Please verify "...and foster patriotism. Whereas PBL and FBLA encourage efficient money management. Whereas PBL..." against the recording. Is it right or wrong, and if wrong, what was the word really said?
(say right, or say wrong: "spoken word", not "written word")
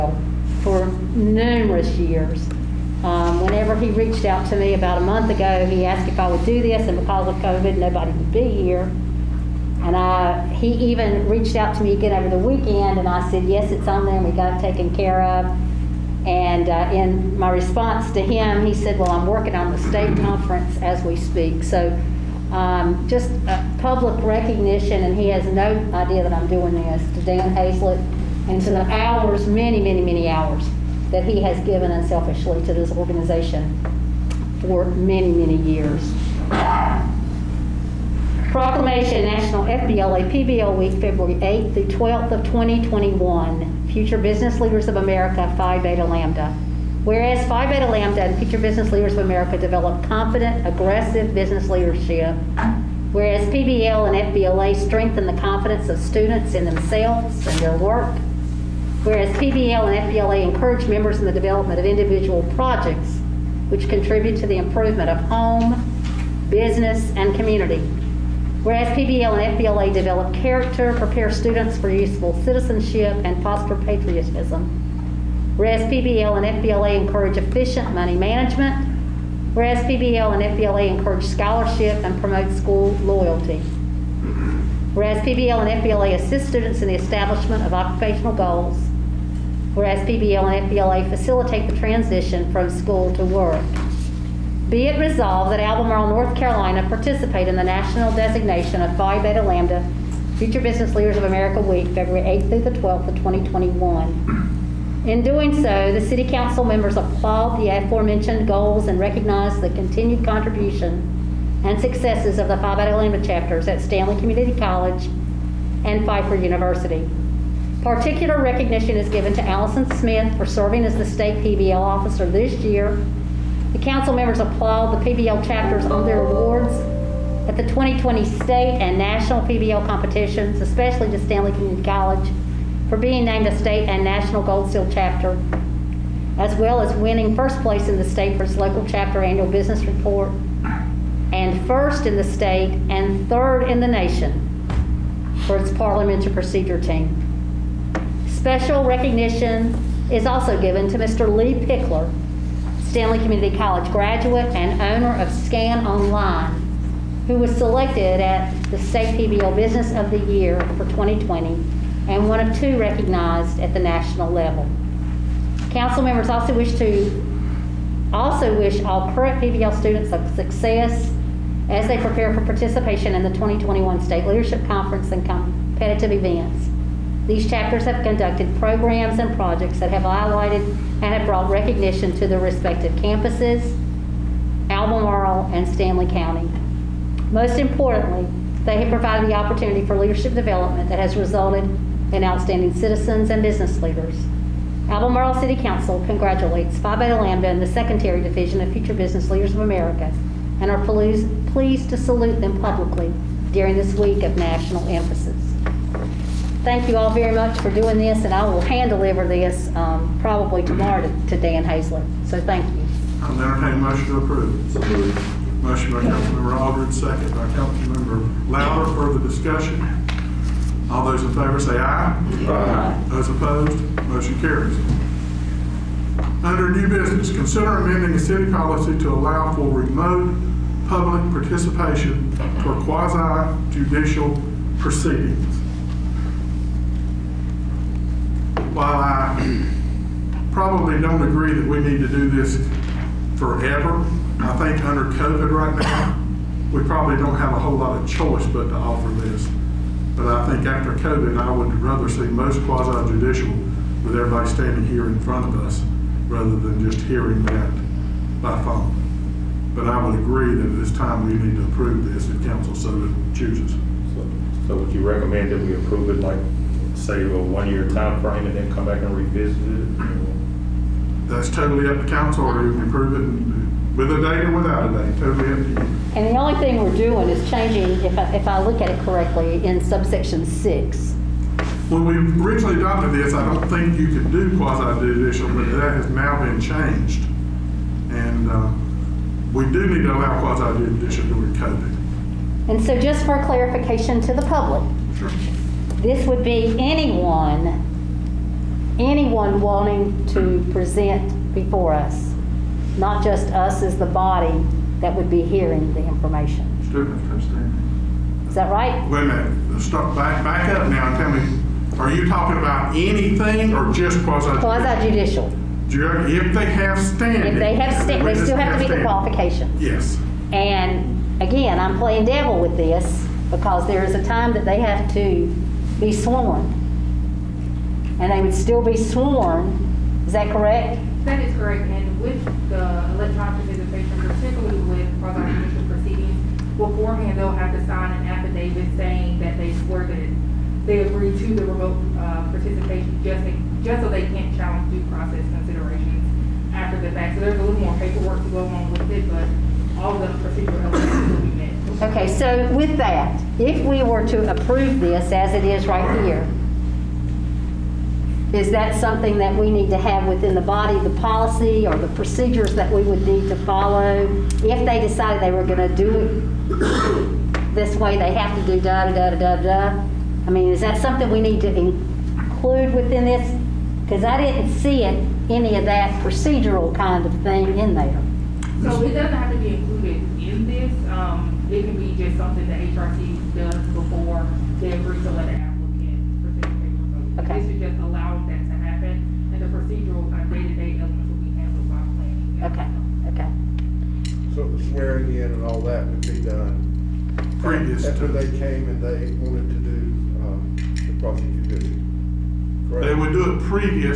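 right.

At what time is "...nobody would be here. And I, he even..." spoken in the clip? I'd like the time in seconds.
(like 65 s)
7 s.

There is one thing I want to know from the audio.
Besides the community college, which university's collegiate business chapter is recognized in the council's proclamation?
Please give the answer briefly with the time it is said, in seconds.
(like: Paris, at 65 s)
Pfeiffer University, at 116 s.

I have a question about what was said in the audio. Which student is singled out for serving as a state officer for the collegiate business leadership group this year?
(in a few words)
Allison Smith.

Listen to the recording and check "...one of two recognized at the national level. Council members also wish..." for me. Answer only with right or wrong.
right.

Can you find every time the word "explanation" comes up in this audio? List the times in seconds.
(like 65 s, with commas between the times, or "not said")
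not said.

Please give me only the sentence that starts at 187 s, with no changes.
Most importantly, they have provided the opportunity for leadership development that has resulted in outstanding citizens and business leaders.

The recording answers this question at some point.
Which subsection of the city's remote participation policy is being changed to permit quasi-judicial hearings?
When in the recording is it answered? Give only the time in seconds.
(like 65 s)
279 s.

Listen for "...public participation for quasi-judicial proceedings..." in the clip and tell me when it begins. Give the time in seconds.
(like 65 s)
230 s.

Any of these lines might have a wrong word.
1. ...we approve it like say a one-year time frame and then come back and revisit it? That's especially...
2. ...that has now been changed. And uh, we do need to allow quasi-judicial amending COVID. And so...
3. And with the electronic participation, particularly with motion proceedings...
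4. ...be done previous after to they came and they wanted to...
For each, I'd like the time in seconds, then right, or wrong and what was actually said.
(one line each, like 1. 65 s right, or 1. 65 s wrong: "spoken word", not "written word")
1. 265 s wrong: "totally", not "especially"
2. 285 s wrong: "during", not "amending"
3. 331 s wrong: "prosecution", not "motion"
4. 396 s right.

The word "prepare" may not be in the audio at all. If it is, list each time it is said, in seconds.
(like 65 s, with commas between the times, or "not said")
70 s, 171 s.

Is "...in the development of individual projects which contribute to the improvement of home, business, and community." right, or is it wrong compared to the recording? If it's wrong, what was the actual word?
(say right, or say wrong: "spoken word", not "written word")
right.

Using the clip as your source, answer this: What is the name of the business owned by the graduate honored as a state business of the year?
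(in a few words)
Scan Online.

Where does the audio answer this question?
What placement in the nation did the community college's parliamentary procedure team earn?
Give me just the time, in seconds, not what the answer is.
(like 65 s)
143 s.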